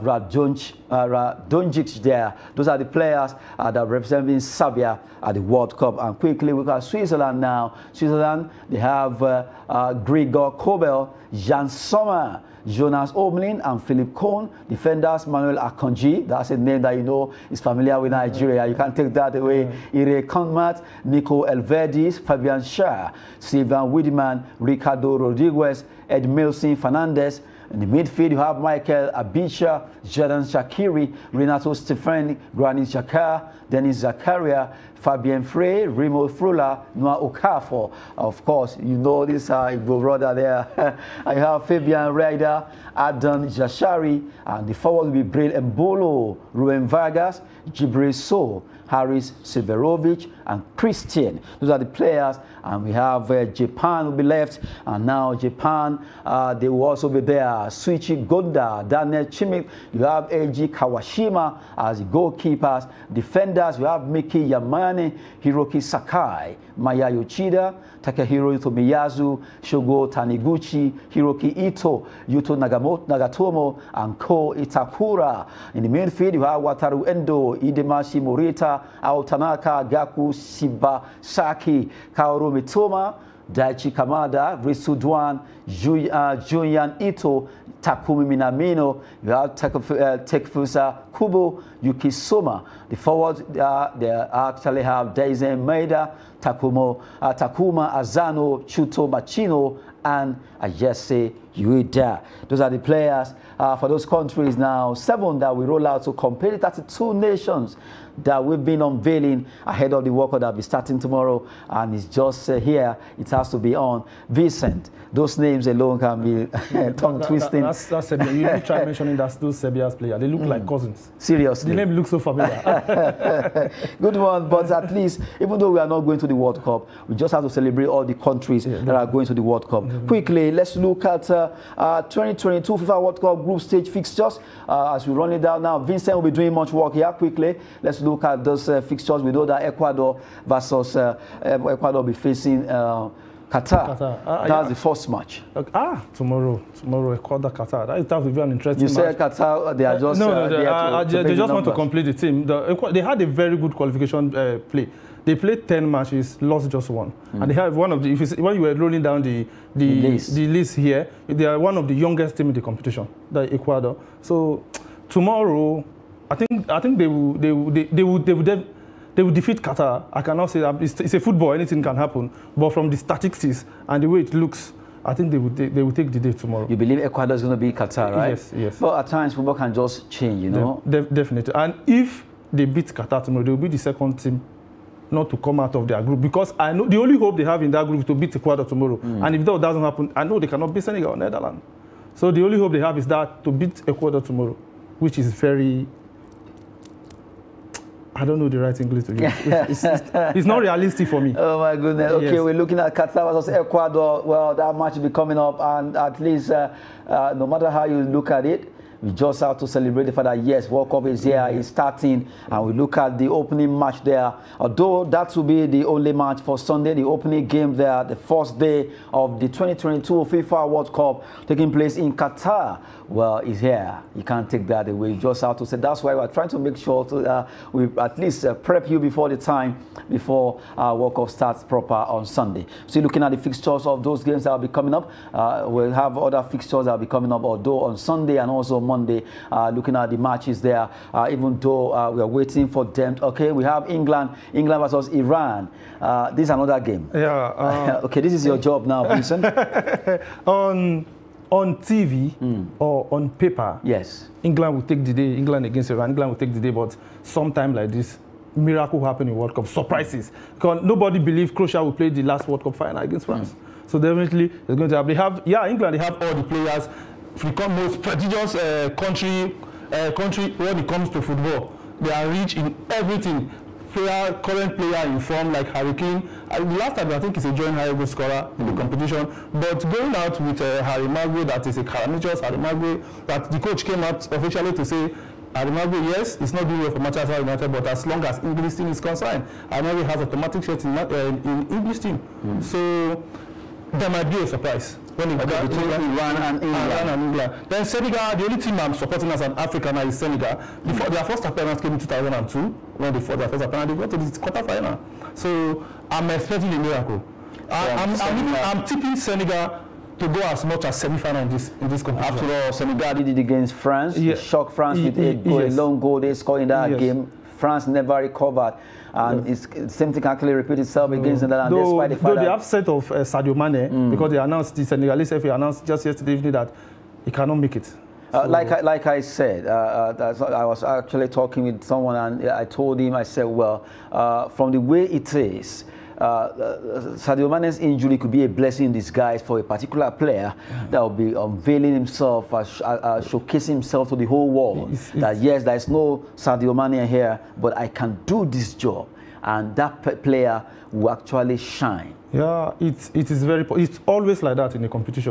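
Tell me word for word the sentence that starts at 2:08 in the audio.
are going to the World Cup.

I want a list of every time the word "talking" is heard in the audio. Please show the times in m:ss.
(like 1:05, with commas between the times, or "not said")
5:31.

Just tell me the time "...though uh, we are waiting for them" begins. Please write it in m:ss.
4:01.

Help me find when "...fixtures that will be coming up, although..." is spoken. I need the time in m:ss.
3:56.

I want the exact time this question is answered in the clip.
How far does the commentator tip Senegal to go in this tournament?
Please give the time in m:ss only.
5:10.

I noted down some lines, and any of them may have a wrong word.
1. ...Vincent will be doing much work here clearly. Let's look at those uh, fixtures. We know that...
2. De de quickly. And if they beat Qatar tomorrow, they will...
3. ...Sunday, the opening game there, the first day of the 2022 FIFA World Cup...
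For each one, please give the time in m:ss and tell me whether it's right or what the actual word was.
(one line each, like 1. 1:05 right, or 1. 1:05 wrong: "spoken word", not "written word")
1. 2:15 wrong: "quickly", not "clearly"
2. 3:00 wrong: "definitely", not "quickly"
3. 3:36 right.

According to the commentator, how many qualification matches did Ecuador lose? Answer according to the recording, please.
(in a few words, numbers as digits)
1.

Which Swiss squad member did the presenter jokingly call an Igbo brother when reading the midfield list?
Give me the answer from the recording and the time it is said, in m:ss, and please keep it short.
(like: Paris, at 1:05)
Noah Okafor, at 0:36.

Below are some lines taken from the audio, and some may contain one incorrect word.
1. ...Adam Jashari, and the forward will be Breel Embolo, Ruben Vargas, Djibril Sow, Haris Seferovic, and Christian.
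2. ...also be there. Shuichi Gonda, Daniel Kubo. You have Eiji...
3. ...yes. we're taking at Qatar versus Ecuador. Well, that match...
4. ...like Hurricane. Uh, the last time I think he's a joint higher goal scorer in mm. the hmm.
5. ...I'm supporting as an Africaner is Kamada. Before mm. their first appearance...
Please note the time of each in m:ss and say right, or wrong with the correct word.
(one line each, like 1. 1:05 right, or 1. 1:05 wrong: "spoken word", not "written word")
1. 0:42 right
2. 0:56 wrong: "Schmidt", not "Kubo"
3. 3:22 wrong: "looking", not "taking"
4. 4:35 right
5. 4:58 wrong: "Senegal", not "Kamada".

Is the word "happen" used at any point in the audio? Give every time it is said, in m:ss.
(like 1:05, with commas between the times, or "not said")
2:51, 3:09, 4:19, 4:24.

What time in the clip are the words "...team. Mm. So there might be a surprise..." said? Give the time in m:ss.
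4:51.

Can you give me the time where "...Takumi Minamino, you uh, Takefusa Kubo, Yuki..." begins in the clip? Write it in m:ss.
1:27.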